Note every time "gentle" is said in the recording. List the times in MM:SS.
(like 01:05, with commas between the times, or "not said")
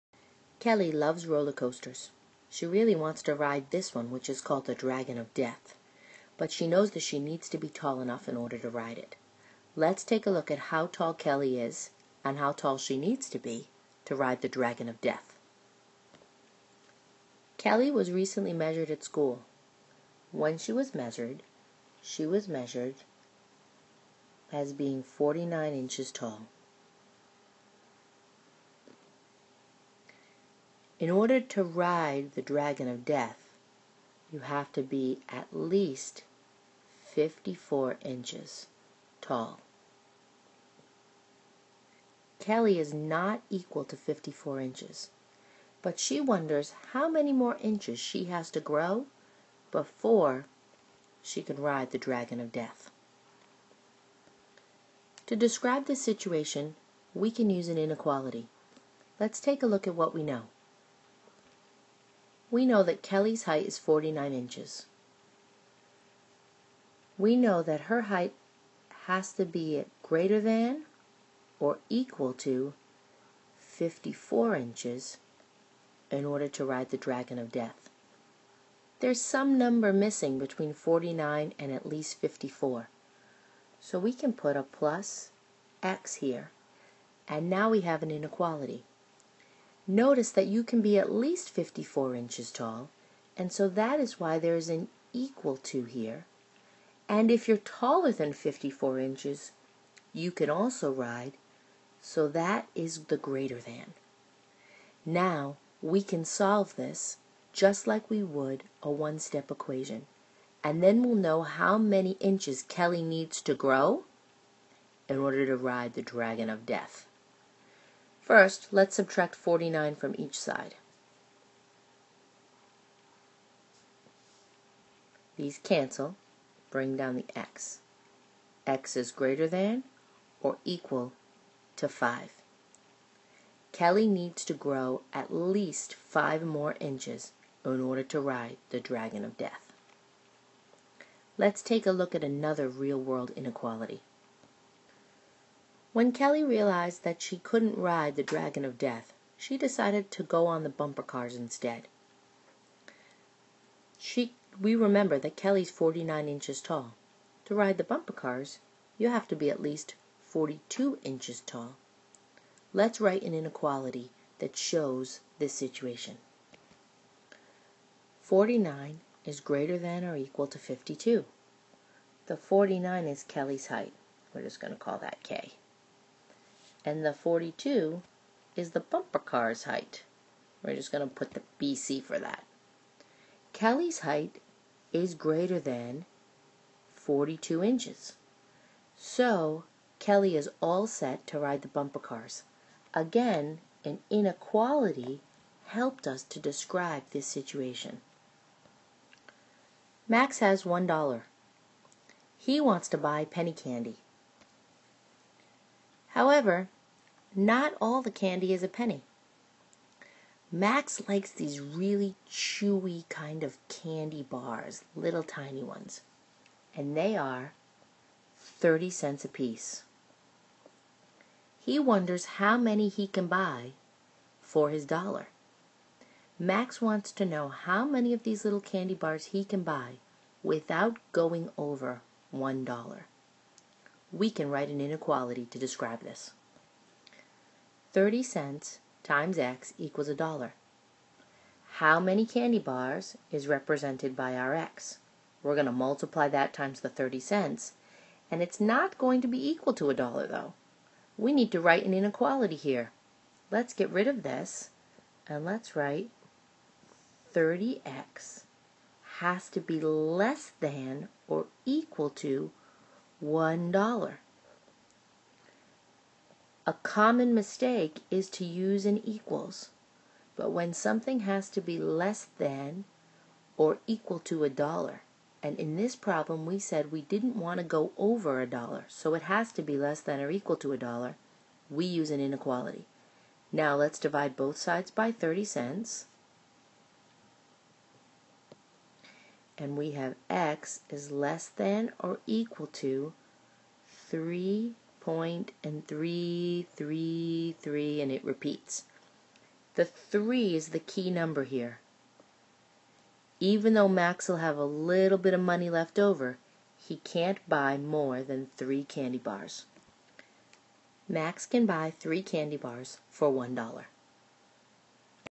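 not said.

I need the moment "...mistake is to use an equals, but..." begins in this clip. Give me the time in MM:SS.
04:27.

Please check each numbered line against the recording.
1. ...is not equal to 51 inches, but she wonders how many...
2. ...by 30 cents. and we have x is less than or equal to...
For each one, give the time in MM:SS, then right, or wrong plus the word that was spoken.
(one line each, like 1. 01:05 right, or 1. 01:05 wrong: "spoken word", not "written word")
1. 00:42 wrong: "54", not "51"
2. 04:44 right.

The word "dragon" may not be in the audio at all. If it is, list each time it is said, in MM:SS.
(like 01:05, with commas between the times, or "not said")
00:04, 00:14, 00:32, 00:51, 01:16, 01:56, 02:18, 02:28.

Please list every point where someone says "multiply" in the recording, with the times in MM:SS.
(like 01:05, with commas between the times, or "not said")
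04:05.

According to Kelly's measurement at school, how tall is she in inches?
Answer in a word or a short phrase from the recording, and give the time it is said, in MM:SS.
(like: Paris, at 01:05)
49 inches, at 00:25.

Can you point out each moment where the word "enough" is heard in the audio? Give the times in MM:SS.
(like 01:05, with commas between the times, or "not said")
00:07.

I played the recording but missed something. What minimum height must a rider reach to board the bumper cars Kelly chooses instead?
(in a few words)
42 inches.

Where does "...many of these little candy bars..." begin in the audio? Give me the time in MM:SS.
03:47.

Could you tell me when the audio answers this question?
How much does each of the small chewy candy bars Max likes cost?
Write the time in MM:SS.
03:38.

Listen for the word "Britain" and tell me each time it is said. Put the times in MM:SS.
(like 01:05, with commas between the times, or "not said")
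not said.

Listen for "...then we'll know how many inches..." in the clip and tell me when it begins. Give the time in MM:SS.
01:50.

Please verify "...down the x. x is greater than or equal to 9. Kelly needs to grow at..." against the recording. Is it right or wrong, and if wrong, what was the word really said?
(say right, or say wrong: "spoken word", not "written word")
wrong: "5", not "9".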